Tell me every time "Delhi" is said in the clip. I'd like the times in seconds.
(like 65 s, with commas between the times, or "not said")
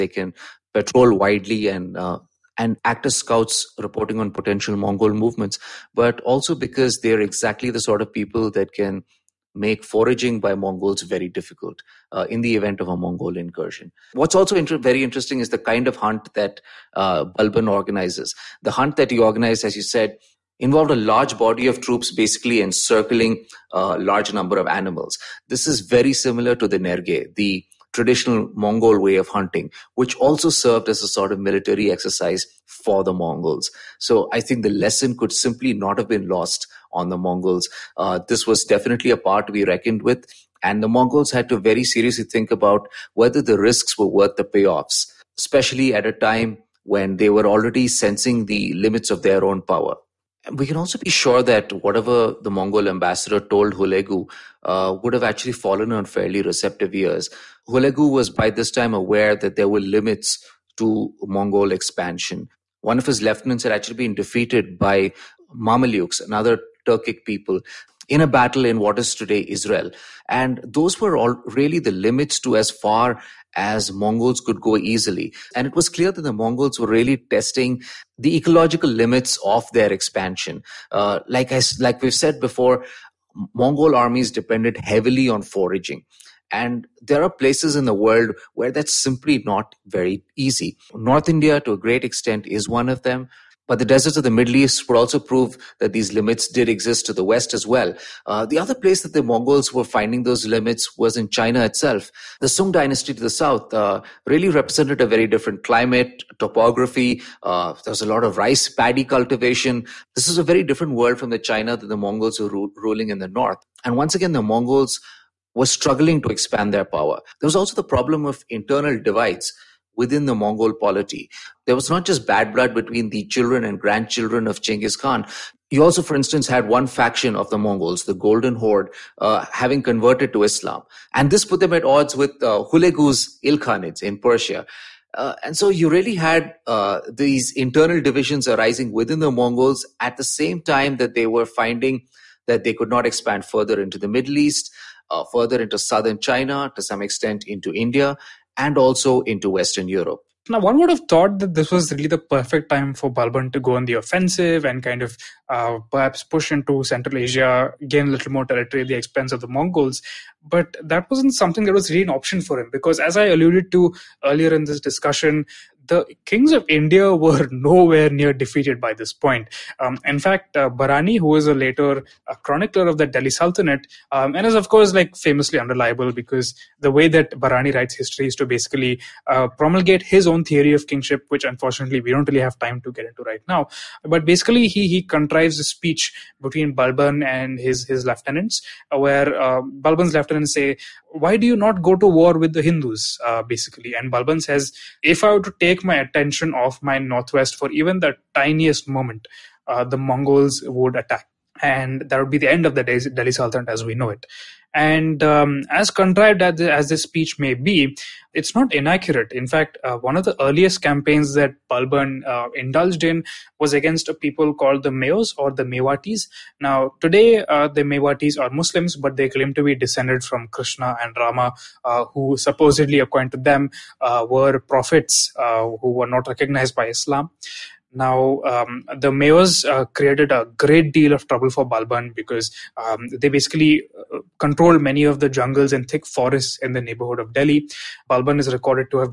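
173 s, 203 s, 237 s.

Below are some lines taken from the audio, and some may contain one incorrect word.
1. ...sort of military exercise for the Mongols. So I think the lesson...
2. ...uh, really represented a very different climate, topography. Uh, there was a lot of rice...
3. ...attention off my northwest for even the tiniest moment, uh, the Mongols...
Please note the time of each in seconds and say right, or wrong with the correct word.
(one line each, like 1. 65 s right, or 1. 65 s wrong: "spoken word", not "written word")
1. 31 s right
2. 103 s right
3. 195 s right.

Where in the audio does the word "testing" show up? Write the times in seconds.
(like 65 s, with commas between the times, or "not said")
77 s.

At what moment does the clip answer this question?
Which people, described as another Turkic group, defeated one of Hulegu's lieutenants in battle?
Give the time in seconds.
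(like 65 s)
65 s.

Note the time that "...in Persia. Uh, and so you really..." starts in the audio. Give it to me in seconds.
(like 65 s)
134 s.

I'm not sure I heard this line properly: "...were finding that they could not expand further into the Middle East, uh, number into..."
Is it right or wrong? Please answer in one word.
wrong.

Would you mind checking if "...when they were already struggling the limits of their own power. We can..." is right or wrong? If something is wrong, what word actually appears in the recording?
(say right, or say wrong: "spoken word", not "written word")
wrong: "sensing", not "struggling".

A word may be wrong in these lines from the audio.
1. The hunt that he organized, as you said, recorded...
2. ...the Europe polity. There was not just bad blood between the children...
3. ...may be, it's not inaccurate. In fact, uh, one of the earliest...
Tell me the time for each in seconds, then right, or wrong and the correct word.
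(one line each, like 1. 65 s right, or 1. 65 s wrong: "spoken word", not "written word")
1. 18 s wrong: "involved", not "recorded"
2. 120 s wrong: "Mongol", not "Europe"
3. 207 s right.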